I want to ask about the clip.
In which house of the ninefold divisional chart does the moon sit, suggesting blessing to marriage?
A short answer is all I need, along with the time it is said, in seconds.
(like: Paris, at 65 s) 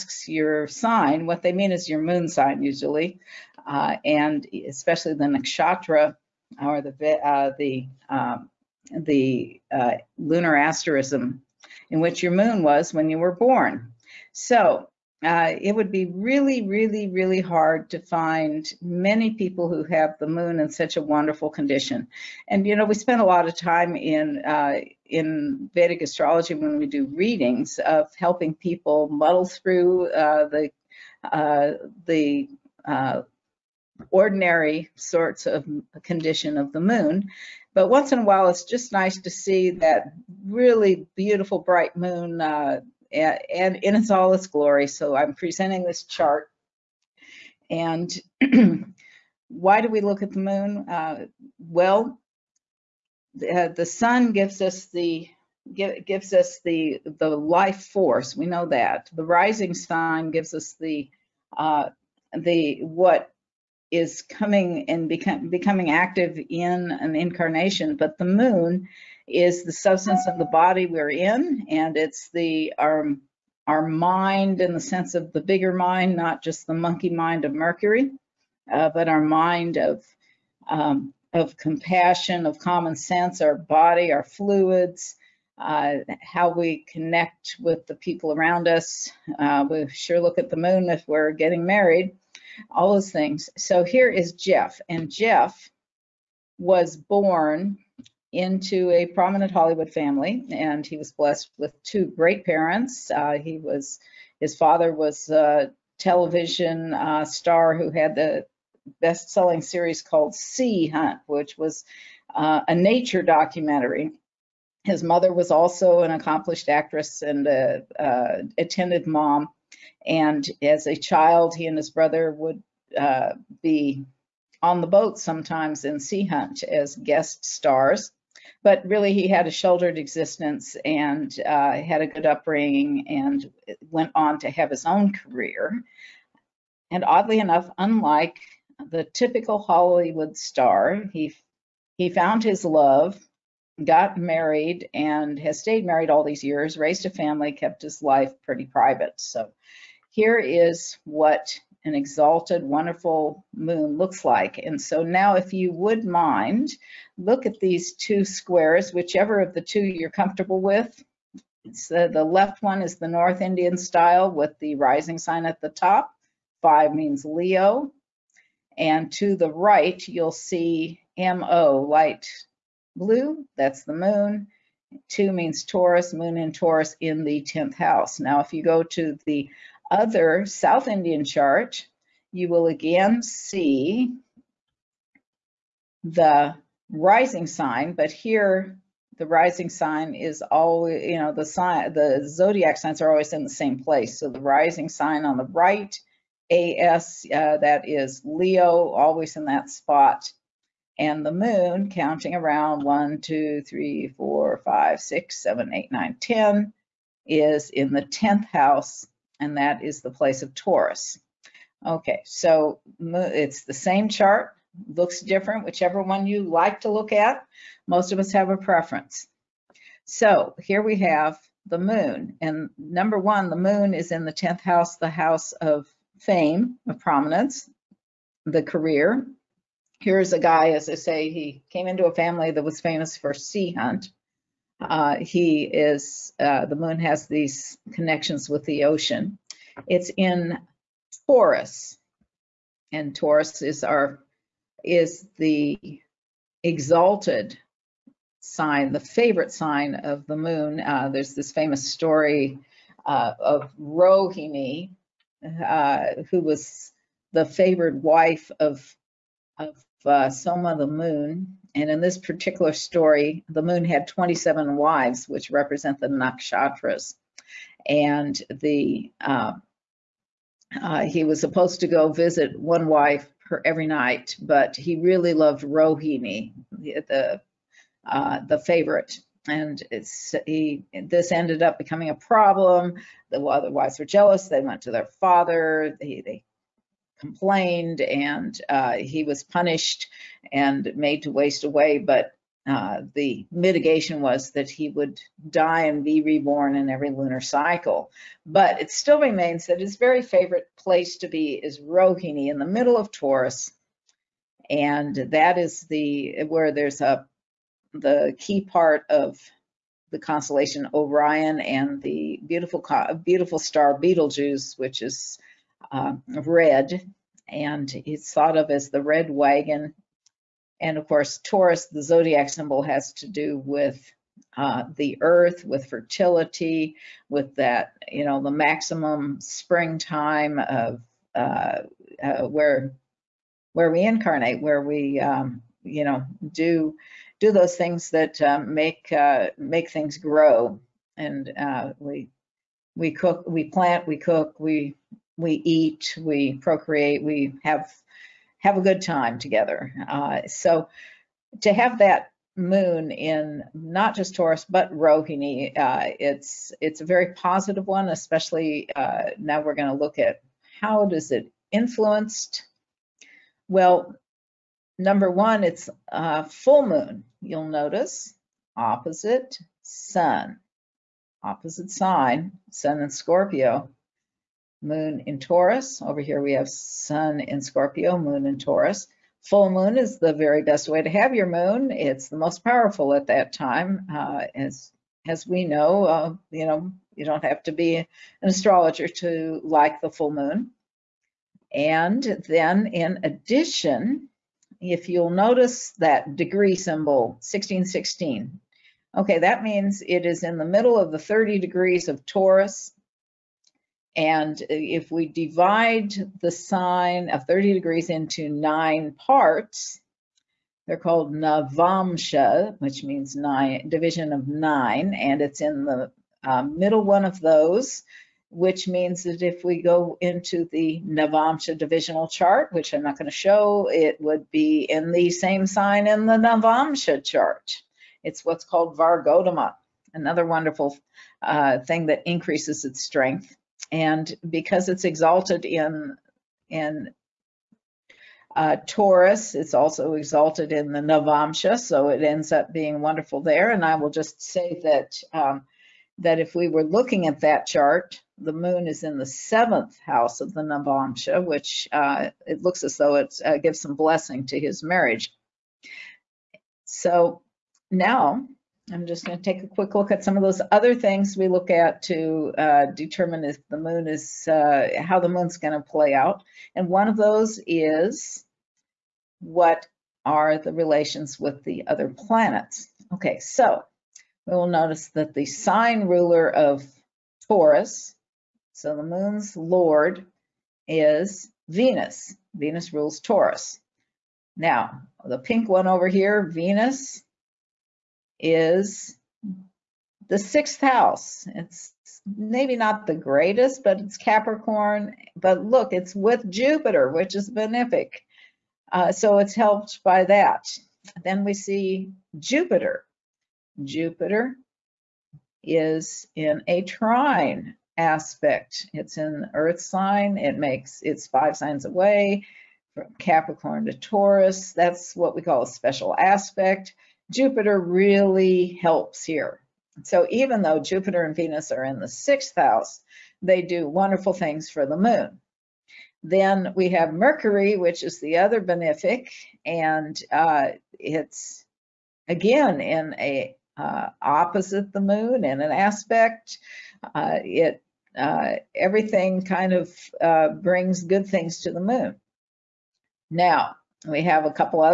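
seventh house, at 449 s.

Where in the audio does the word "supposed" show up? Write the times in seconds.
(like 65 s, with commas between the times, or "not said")
271 s.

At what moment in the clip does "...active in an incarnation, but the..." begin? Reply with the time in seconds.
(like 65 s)
65 s.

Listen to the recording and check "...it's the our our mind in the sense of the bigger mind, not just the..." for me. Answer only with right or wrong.
right.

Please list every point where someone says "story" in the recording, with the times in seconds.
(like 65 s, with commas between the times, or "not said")
251 s, 262 s.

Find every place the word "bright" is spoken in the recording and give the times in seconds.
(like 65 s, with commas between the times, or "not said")
41 s.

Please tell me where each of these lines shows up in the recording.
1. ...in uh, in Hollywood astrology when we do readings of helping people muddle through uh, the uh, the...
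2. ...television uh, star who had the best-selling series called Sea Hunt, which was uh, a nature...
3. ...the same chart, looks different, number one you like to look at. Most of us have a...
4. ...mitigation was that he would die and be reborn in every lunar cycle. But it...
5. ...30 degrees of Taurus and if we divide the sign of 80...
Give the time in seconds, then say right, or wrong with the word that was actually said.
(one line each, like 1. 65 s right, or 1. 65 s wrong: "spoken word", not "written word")
1. 23 s wrong: "Vedic", not "Hollywood"
2. 105 s right
3. 213 s wrong: "whichever", not "number"
4. 293 s right
5. 401 s wrong: "30", not "80".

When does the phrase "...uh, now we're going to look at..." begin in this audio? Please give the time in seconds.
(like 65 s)
358 s.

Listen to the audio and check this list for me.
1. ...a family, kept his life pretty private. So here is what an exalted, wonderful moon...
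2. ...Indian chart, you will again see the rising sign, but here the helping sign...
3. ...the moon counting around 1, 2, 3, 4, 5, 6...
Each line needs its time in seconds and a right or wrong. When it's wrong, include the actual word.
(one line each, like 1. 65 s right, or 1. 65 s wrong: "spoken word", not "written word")
1. 147 s right
2. 180 s wrong: "rising", not "helping"
3. 201 s right.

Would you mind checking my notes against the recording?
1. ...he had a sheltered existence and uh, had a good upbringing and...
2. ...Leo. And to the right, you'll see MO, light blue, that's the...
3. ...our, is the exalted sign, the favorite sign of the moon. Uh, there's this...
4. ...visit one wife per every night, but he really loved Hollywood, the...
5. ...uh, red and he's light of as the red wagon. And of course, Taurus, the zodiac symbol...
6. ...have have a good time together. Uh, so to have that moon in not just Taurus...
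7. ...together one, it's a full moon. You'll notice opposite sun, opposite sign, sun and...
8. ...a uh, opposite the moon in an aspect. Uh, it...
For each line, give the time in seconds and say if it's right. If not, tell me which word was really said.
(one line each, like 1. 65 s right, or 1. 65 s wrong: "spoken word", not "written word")
1. 129 s right
2. 167 s right
3. 243 s right
4. 272 s wrong: "Rohini", not "Hollywood"
5. 315 s wrong: "thought", not "light"
6. 347 s right
7. 364 s wrong: "number", not "together"
8. 533 s right.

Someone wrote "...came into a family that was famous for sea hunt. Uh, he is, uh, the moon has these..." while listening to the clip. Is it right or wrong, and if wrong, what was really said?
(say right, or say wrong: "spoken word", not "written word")
right.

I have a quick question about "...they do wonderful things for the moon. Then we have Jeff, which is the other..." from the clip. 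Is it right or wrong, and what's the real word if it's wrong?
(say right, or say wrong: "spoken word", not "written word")
wrong: "Mercury", not "Jeff".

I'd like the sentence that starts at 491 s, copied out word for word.
It's maybe not the greatest, but it's Capricorn.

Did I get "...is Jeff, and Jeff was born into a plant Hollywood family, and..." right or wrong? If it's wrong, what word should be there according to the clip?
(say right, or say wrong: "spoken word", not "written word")
wrong: "prominent", not "plant".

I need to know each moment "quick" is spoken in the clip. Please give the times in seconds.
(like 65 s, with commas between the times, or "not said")
459 s.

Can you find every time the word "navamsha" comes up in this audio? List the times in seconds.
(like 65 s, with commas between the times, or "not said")
411 s, 421 s, 426 s, 440 s, 450 s.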